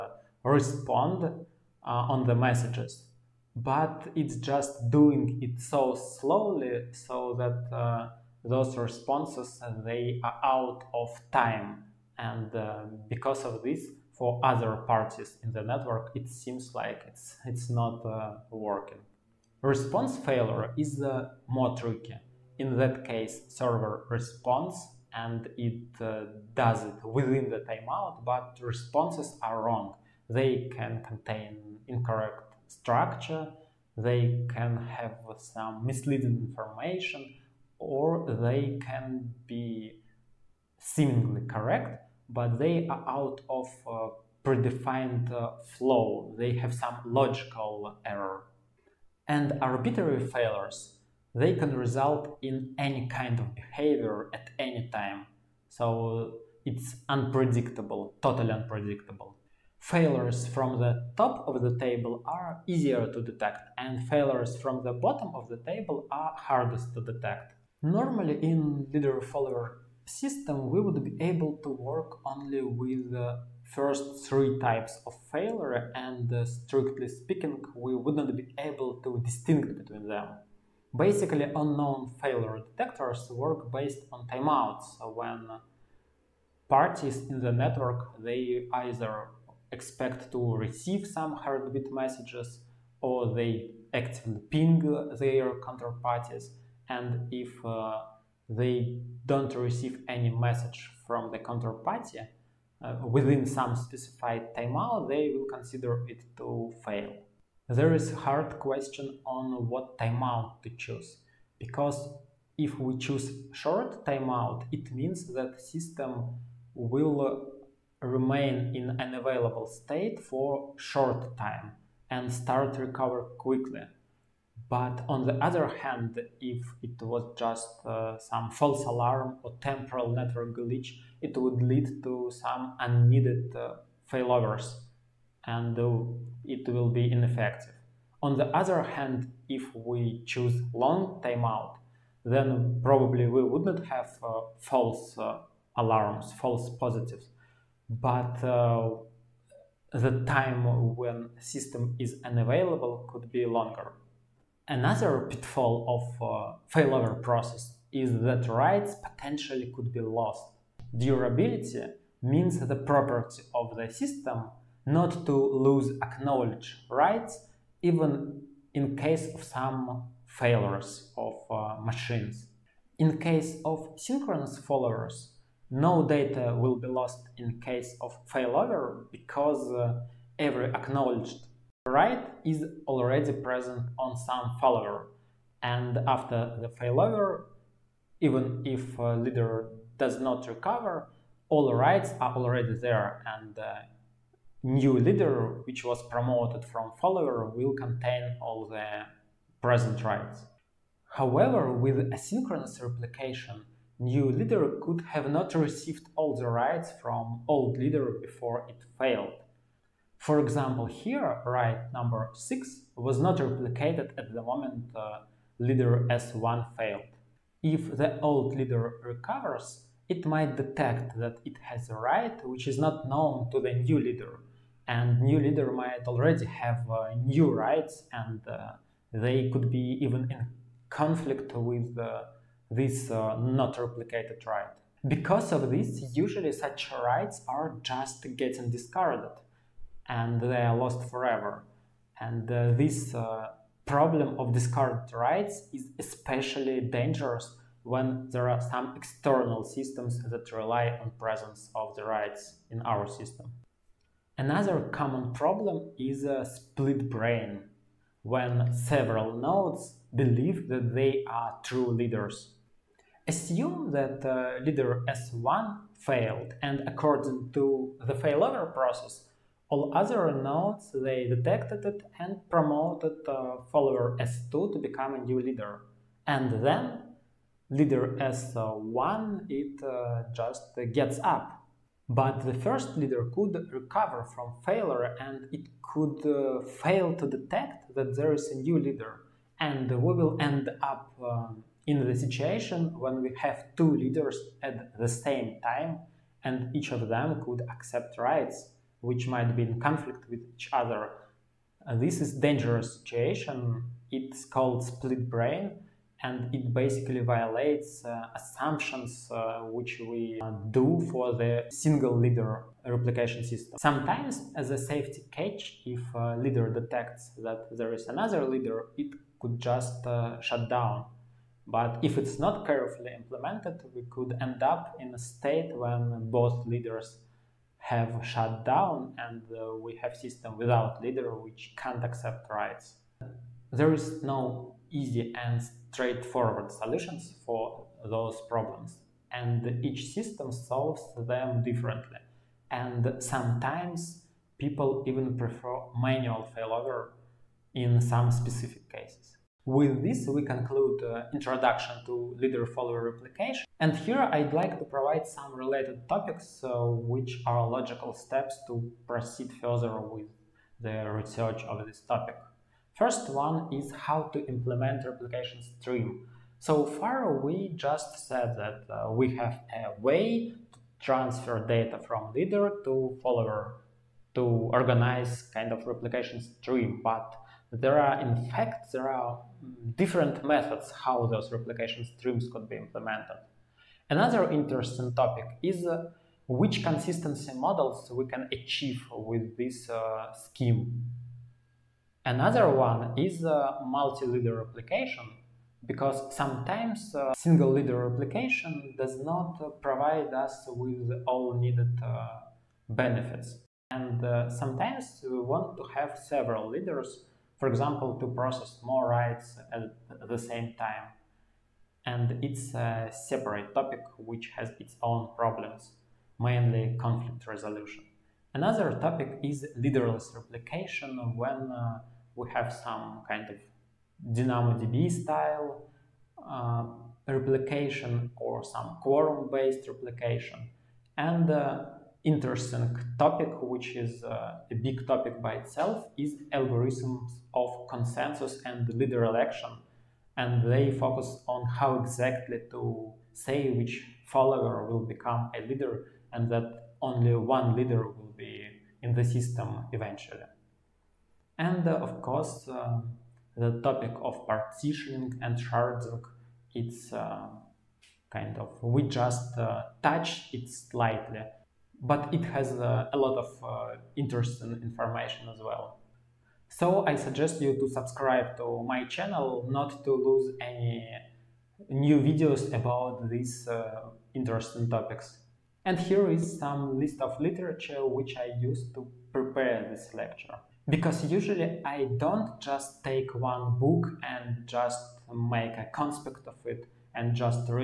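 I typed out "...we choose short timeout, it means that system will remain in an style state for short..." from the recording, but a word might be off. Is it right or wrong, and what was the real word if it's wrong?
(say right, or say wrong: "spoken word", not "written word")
wrong: "available", not "style".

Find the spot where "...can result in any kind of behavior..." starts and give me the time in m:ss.
0:51.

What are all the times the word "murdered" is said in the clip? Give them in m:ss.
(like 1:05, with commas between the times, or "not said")
not said.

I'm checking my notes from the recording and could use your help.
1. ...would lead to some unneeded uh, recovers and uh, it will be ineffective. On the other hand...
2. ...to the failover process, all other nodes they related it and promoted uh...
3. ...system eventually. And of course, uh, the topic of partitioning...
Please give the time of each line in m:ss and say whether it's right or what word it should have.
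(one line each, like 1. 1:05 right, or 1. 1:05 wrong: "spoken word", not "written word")
1. 2:11 wrong: "failovers", not "recovers"
2. 4:27 wrong: "detected", not "related"
3. 7:29 right.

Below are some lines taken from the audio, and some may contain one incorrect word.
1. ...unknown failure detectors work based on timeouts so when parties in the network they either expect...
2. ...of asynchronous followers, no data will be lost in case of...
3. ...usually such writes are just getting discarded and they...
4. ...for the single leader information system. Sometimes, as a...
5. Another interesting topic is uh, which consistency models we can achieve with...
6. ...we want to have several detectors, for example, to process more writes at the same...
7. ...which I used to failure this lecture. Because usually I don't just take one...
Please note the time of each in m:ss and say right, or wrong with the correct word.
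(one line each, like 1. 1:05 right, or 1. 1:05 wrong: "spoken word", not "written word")
1. 1:21 right
2. 2:53 wrong: "synchronous", not "asynchronous"
3. 3:56 right
4. 5:11 wrong: "replication", not "information"
5. 6:24 right
6. 6:45 wrong: "leaders", not "detectors"
7. 7:58 wrong: "prepare", not "failure".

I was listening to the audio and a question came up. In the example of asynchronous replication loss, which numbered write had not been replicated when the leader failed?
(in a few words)
6.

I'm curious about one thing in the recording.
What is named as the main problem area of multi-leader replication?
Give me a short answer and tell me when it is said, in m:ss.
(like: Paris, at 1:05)
Conflict resolution, at 6:56.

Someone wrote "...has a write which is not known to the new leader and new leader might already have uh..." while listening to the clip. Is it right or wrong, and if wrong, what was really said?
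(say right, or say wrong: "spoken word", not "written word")
right.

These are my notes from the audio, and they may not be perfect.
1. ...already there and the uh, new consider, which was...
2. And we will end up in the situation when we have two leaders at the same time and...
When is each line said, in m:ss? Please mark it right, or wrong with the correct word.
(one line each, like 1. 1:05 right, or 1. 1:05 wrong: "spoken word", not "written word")
1. 3:12 wrong: "leader", not "consider"
2. 4:49 right.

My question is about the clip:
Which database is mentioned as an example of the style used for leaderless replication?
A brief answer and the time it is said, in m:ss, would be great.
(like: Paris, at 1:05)
DynamoDB, at 7:04.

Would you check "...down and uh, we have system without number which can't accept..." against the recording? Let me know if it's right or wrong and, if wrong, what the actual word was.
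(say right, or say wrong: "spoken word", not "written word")
wrong: "leader", not "number".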